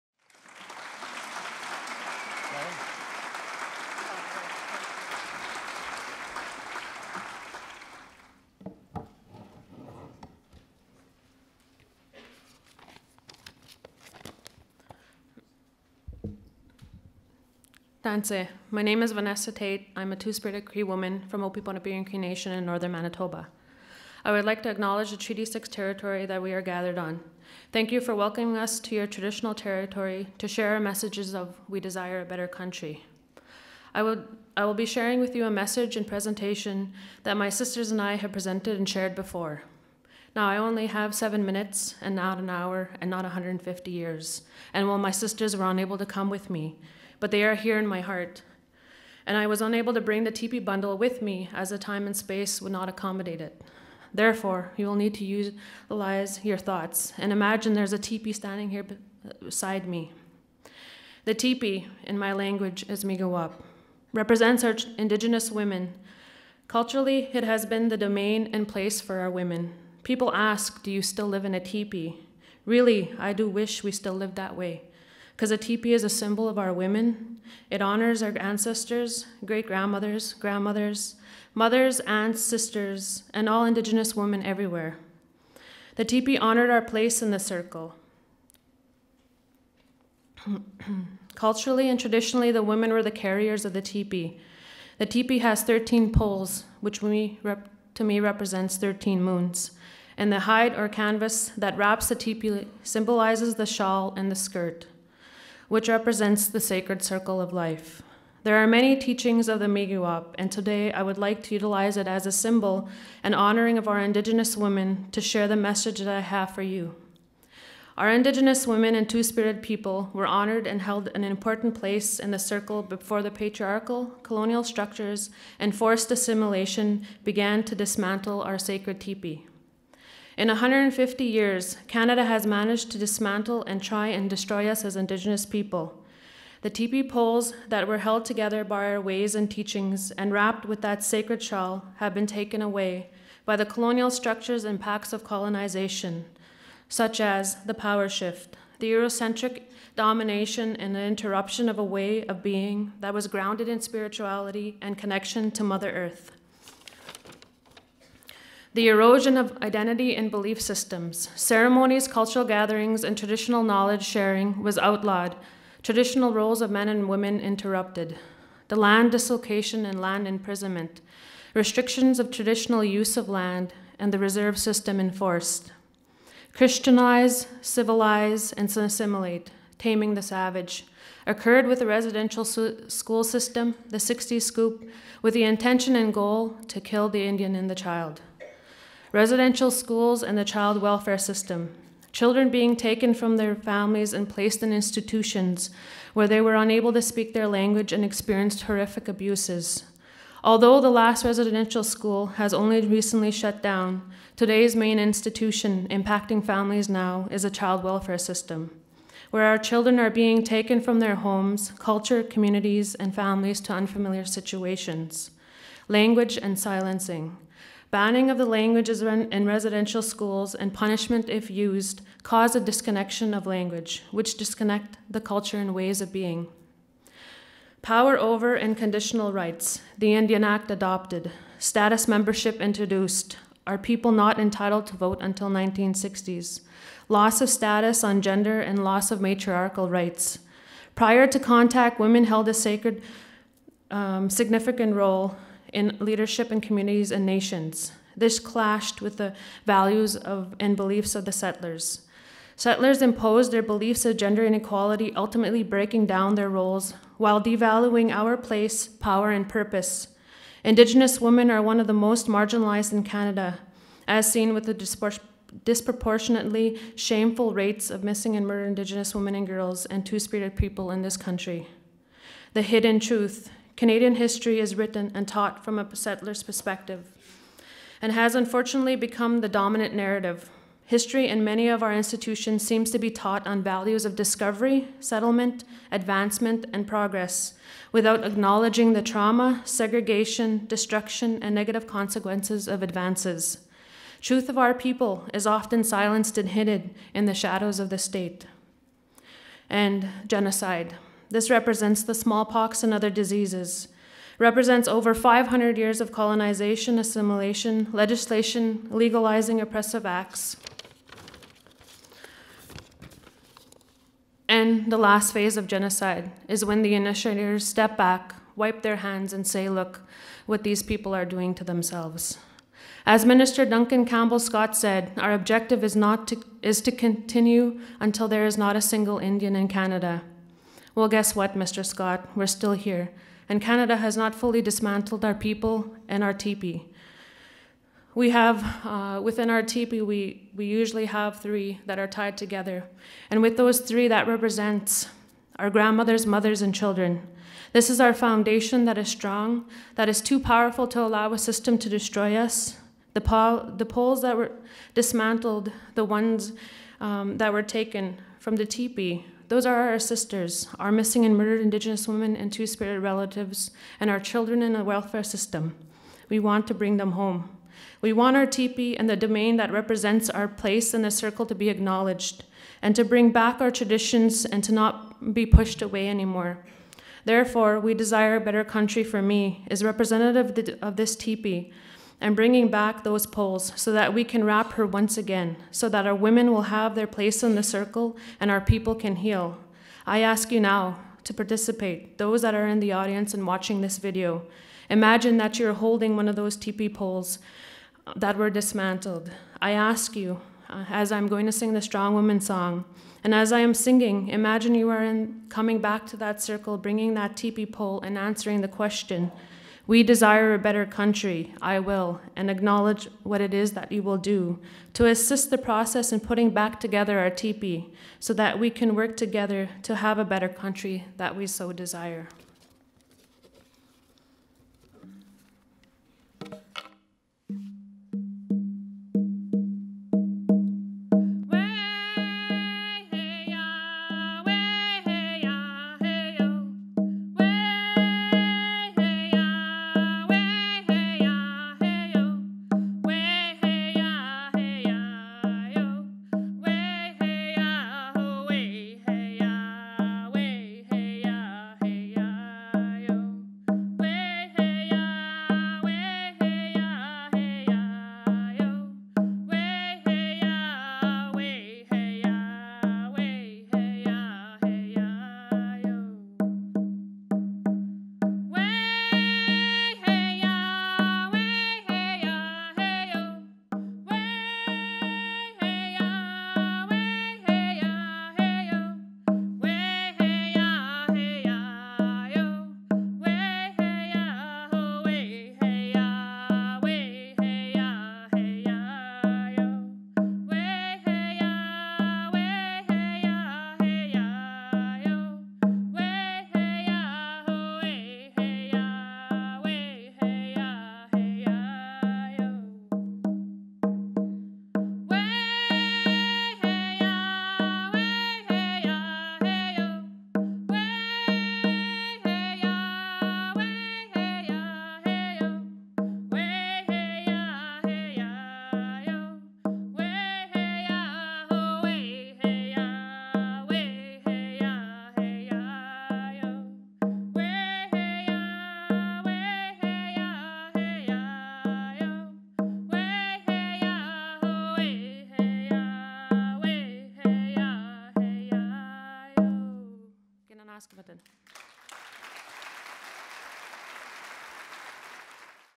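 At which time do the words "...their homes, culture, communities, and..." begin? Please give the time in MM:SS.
03:30.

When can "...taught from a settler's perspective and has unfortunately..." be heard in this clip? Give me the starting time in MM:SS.
04:35.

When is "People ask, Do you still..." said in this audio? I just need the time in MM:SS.
01:10.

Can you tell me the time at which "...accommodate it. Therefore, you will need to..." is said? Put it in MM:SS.
00:52.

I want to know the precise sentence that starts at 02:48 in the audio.
The land dislocation and land imprisonment, restrictions of traditional use of land, and the reserve system enforced.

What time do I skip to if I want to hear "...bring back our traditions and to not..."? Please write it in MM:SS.
06:13.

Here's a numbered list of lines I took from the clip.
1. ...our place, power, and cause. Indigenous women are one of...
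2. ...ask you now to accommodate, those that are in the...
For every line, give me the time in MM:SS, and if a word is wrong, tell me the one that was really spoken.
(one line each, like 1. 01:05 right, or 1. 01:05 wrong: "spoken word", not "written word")
1. 04:18 wrong: "purpose", not "cause"
2. 06:30 wrong: "participate", not "accommodate".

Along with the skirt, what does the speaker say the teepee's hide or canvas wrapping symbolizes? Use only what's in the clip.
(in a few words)
the shawl.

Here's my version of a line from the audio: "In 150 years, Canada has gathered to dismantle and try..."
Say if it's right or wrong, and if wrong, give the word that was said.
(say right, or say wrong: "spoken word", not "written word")
wrong: "managed", not "gathered".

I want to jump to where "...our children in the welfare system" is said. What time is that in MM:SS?
06:04.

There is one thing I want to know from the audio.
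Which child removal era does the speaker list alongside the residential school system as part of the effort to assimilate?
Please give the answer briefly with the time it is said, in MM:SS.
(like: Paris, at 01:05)
the 60s scoop, at 03:03.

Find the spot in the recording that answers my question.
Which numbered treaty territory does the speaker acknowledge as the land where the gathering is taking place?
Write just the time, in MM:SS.
00:25.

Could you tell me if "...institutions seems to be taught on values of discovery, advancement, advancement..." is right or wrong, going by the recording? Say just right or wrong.
wrong.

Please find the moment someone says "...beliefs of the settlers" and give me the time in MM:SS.
04:10.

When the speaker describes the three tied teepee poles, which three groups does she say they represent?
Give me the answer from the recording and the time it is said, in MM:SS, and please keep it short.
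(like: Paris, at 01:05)
grandmothers, mothers, and children, at 05:45.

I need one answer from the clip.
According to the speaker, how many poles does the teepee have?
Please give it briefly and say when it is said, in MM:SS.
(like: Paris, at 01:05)
13, at 01:35.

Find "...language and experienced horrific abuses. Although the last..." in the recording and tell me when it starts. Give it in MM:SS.
03:17.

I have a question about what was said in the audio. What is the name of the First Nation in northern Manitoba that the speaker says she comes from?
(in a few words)
O-Pipon-Na-Piwin Cree Nation.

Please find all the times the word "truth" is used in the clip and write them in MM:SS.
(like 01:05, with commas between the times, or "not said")
04:32, 04:54.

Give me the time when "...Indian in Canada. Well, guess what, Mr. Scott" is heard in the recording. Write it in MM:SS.
05:29.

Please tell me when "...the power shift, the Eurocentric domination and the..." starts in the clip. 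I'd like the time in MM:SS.
02:27.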